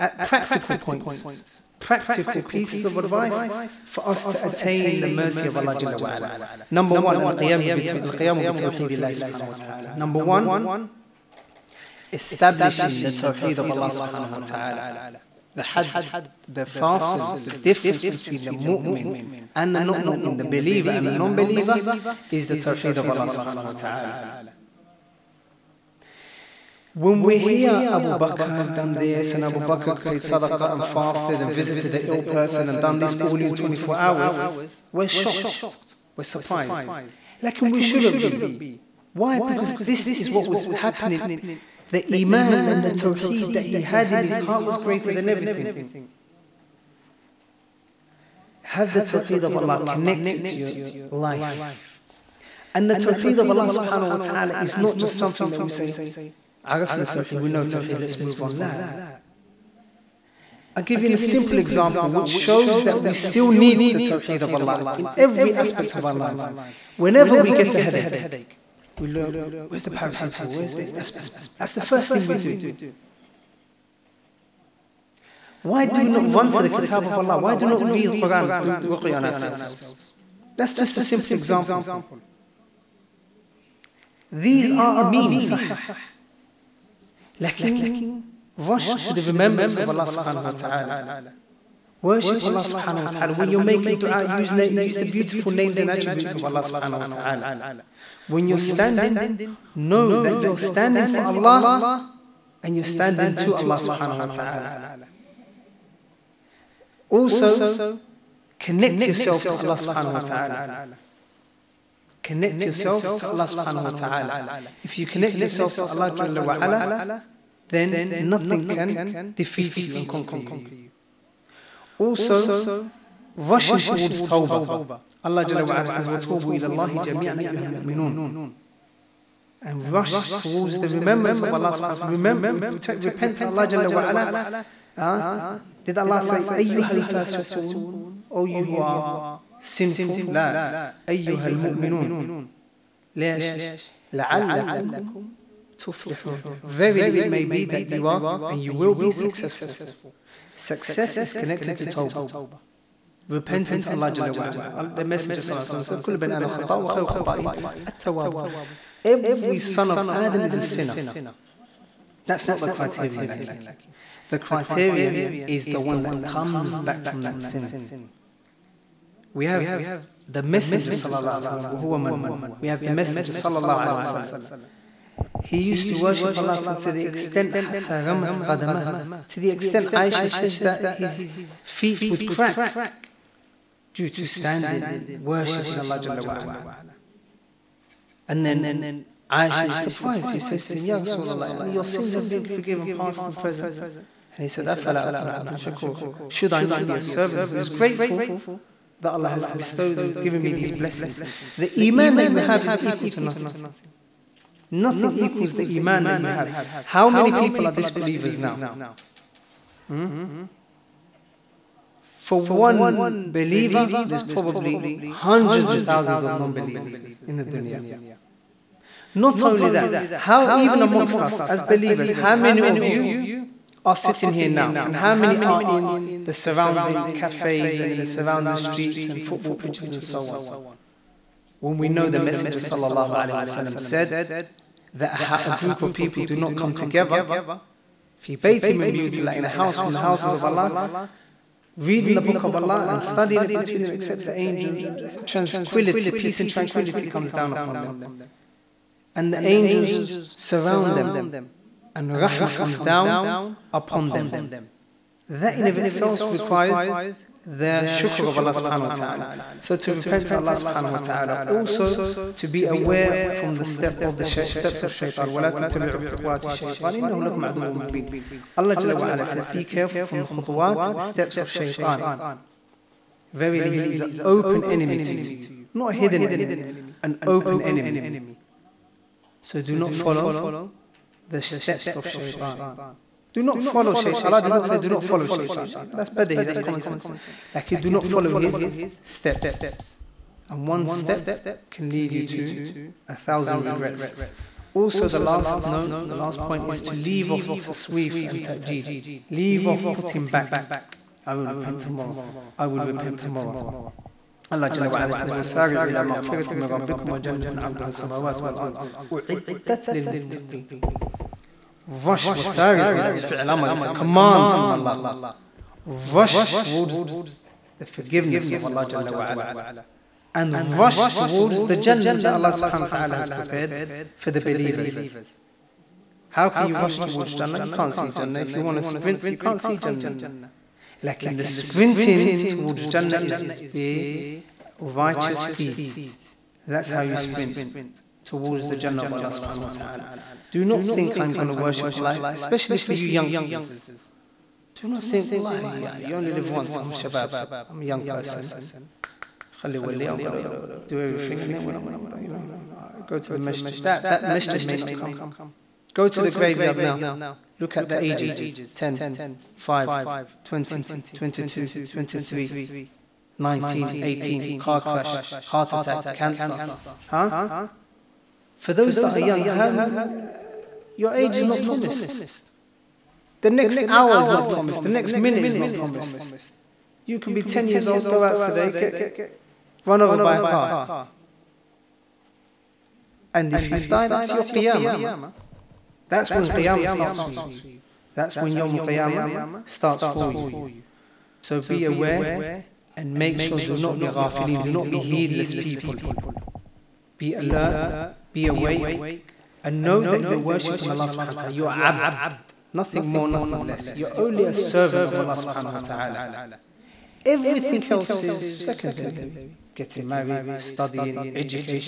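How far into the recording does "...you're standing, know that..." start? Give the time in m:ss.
1:38.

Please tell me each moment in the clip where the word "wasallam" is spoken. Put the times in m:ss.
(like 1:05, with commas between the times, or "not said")
2:53, 3:53.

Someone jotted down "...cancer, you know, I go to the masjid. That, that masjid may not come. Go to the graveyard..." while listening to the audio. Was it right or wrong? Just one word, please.
wrong.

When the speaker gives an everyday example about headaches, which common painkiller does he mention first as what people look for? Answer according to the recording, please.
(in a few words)
paracetamol.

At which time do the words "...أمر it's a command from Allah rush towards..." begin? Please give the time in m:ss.
5:13.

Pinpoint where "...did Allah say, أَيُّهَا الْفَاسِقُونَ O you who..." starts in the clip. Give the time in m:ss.
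2:15.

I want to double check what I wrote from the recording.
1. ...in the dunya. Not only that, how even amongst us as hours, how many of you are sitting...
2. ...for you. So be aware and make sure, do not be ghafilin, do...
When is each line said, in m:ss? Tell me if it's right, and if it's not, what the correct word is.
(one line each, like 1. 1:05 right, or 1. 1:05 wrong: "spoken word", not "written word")
1. 3:37 wrong: "believers", not "hours"
2. 6:30 right.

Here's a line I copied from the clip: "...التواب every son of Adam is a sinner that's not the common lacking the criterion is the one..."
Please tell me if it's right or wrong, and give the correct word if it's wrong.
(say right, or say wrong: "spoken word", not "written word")
wrong: "criterion", not "common".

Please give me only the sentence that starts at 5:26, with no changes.
How can you rush towards Jannah?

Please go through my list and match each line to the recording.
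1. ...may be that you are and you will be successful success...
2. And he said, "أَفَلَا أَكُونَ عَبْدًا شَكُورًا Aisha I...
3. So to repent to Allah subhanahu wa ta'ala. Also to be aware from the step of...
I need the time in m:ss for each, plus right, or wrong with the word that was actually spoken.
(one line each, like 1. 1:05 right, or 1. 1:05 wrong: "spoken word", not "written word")
1. 2:27 right
2. 3:14 wrong: "Should", not "Aisha"
3. 4:19 right.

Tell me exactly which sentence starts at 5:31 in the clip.
Like in the sprinting towards Jannah is be righteous deeds.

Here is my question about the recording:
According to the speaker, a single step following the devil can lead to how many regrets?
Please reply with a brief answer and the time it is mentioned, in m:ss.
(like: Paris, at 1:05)
1000, at 4:53.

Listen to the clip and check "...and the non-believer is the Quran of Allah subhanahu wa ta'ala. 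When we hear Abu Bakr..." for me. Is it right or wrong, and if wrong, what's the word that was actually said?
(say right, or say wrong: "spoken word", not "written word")
wrong: "Tawheed", not "Quran".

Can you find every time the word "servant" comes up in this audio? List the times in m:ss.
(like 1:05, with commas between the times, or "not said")
3:17, 6:44.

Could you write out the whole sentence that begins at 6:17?
You can be 10 years old, go out today, get run over by a car.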